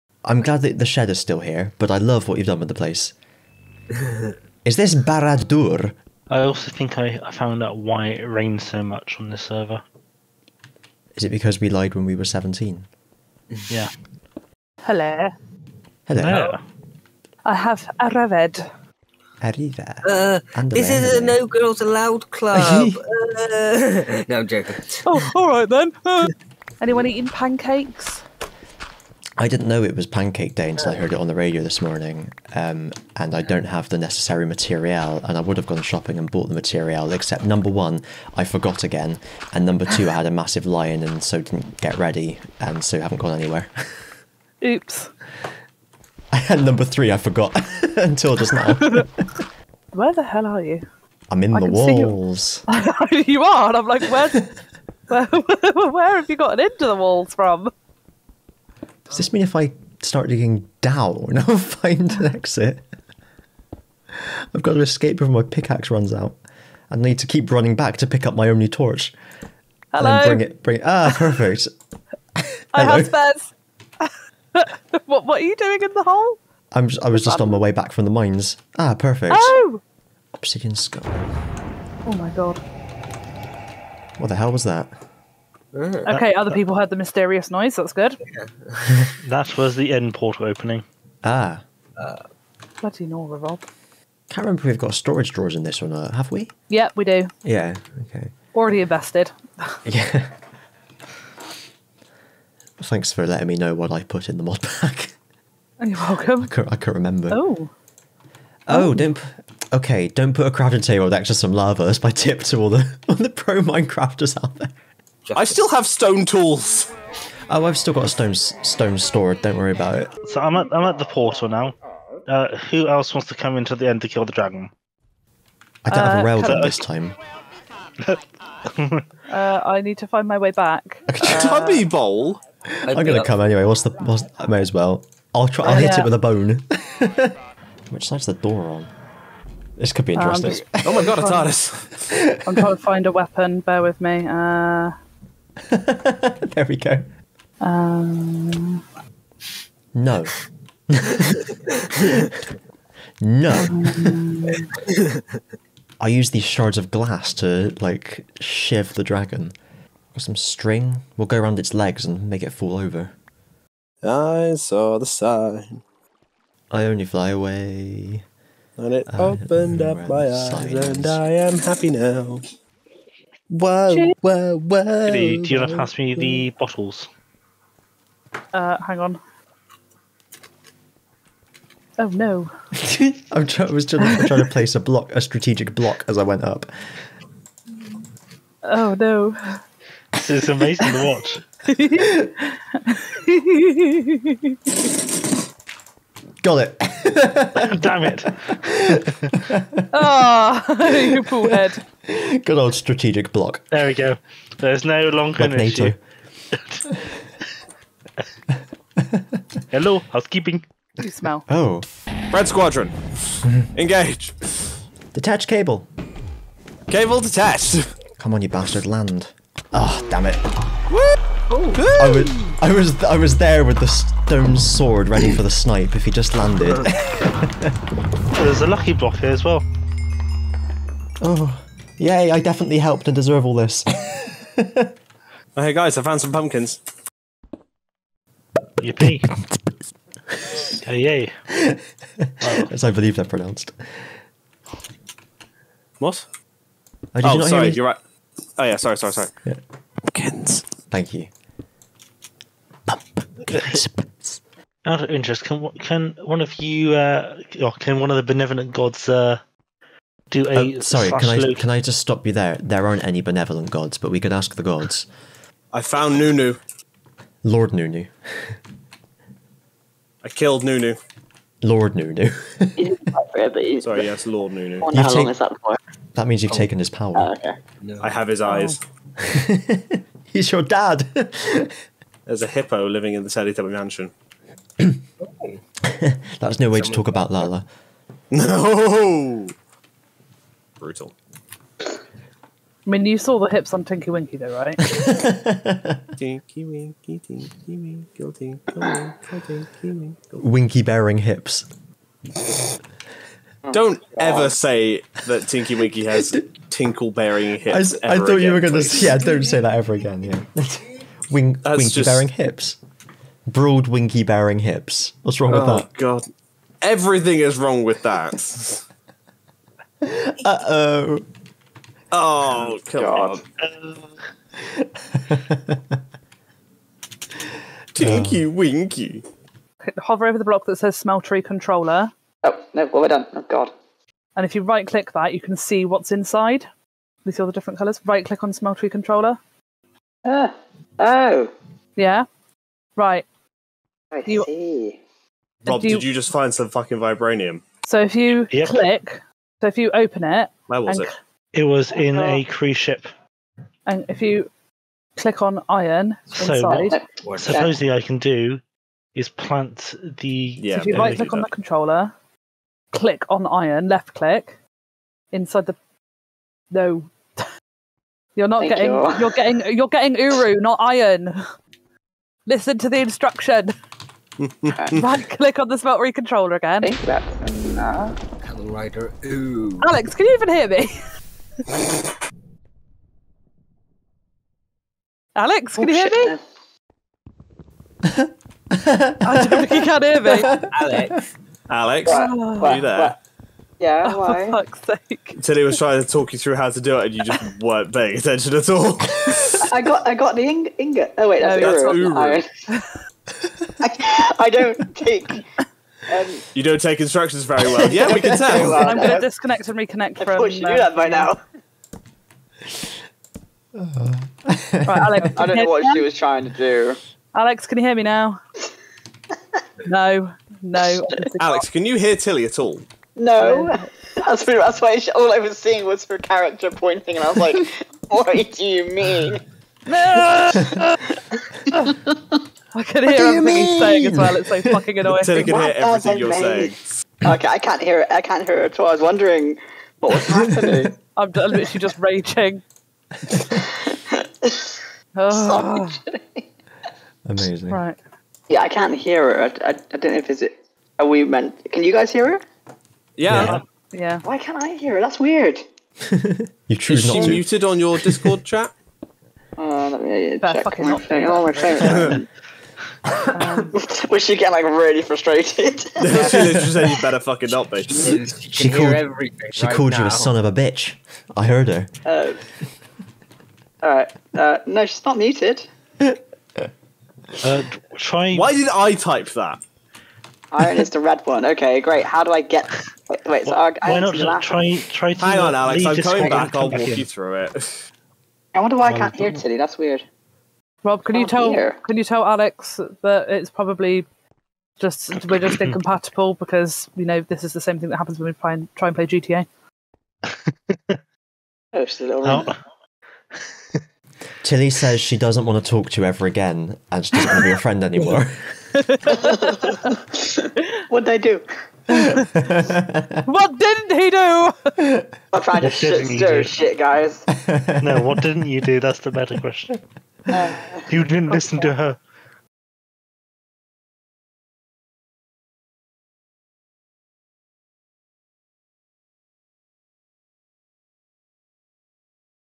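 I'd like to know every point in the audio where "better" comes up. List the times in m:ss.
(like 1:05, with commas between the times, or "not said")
7:40, 7:47, 8:39.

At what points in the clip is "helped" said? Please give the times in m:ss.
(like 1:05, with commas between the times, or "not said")
3:52.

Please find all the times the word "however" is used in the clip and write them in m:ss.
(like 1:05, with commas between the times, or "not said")
not said.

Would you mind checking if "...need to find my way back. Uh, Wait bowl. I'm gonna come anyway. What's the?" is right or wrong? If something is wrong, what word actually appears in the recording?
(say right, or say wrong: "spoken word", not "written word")
wrong: "Tubby", not "Wait".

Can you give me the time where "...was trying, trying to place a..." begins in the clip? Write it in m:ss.
3:03.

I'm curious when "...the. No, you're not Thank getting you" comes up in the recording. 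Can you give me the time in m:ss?
6:05.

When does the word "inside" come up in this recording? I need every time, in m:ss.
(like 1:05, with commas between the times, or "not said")
5:36, 5:56, 6:05.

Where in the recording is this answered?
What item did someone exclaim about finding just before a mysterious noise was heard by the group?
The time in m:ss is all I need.
1:20.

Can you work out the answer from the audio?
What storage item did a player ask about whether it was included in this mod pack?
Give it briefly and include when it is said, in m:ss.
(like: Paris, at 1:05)
storage drawers, at 1:34.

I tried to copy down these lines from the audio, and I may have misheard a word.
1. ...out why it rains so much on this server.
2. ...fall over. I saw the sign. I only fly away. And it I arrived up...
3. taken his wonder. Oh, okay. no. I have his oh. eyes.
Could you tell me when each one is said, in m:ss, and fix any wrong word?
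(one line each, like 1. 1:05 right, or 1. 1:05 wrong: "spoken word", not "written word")
1. 0:07 right
2. 2:42 wrong: "opened", not "arrived"
3. 4:36 wrong: "power", not "wonder".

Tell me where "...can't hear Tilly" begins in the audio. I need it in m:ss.
8:08.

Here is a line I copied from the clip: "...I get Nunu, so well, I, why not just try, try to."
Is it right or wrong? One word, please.
wrong.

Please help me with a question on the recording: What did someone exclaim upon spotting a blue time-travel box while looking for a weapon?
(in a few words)
a TARDIS.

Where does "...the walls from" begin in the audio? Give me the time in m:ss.
0:56.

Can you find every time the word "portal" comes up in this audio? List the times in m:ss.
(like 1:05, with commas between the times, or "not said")
1:30, 2:01.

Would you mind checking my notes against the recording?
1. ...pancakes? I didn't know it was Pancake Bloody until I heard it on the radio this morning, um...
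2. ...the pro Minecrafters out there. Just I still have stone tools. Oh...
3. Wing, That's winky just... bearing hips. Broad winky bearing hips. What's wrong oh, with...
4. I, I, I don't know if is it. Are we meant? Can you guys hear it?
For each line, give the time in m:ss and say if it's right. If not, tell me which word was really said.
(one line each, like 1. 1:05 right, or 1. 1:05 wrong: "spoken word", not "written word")
1. 0:27 wrong: "Day", not "Bloody"
2. 1:53 right
3. 5:11 right
4. 7:29 right.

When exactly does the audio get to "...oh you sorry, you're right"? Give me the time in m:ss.
4:07.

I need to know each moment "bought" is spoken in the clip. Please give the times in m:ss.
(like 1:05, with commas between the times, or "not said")
0:36.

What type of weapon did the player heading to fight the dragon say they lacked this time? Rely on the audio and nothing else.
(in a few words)
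rail gun.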